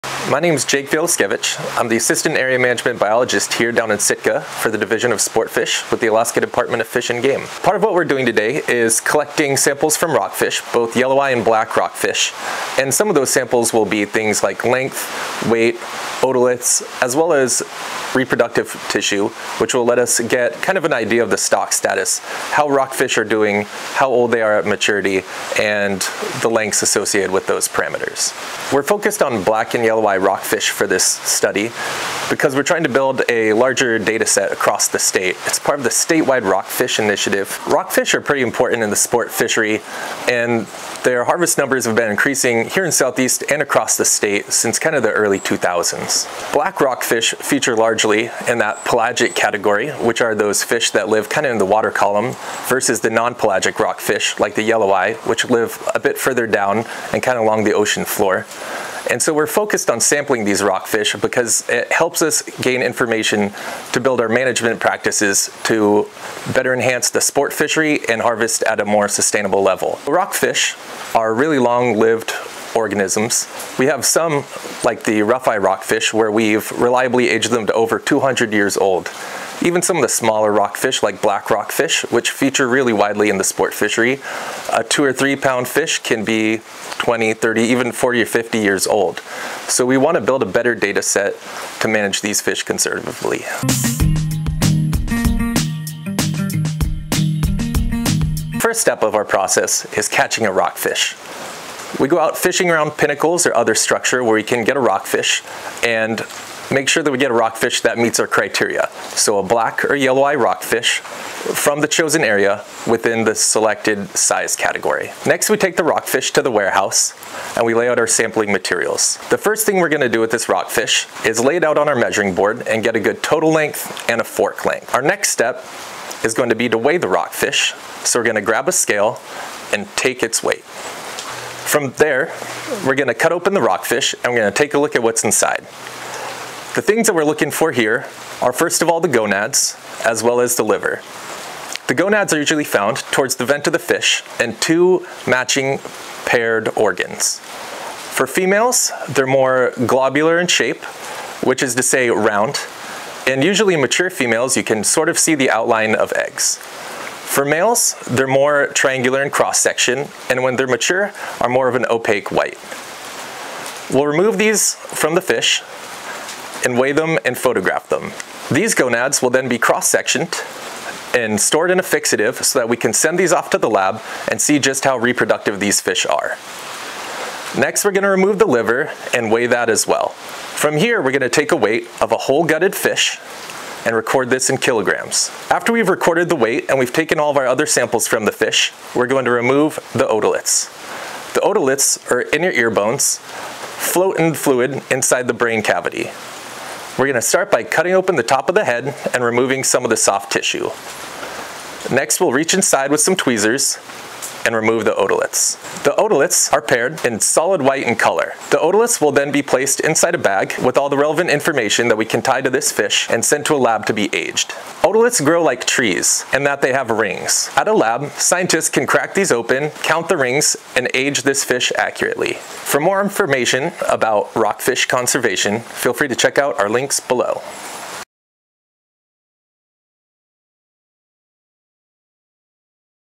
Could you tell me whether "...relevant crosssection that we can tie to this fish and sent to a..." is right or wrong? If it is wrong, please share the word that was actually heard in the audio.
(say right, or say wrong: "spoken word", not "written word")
wrong: "information", not "crosssection".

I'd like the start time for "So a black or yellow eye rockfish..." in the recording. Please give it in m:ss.
1:49.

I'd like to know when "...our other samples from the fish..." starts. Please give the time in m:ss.
3:07.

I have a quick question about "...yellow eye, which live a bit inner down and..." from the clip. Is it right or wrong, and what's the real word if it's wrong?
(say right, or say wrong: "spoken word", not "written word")
wrong: "further", not "inner".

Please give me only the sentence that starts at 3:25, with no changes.
The otoliths are paired in solid white in color.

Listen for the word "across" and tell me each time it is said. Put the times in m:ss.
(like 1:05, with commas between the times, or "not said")
0:34, 0:43.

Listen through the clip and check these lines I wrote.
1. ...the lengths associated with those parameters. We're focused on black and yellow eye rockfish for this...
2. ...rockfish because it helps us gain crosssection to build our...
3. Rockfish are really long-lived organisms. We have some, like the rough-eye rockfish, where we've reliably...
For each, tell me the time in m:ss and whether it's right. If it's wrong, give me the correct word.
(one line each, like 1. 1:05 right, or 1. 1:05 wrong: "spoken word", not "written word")
1. 0:26 right
2. 1:00 wrong: "information", not "crosssection"
3. 1:10 right.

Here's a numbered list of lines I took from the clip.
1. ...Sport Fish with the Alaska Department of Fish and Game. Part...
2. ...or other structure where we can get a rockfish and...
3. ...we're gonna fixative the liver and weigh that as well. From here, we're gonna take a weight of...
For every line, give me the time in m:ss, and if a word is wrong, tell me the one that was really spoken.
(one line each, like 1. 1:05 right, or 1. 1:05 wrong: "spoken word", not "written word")
1. 0:05 right
2. 1:43 right
3. 2:57 wrong: "remove", not "fixative".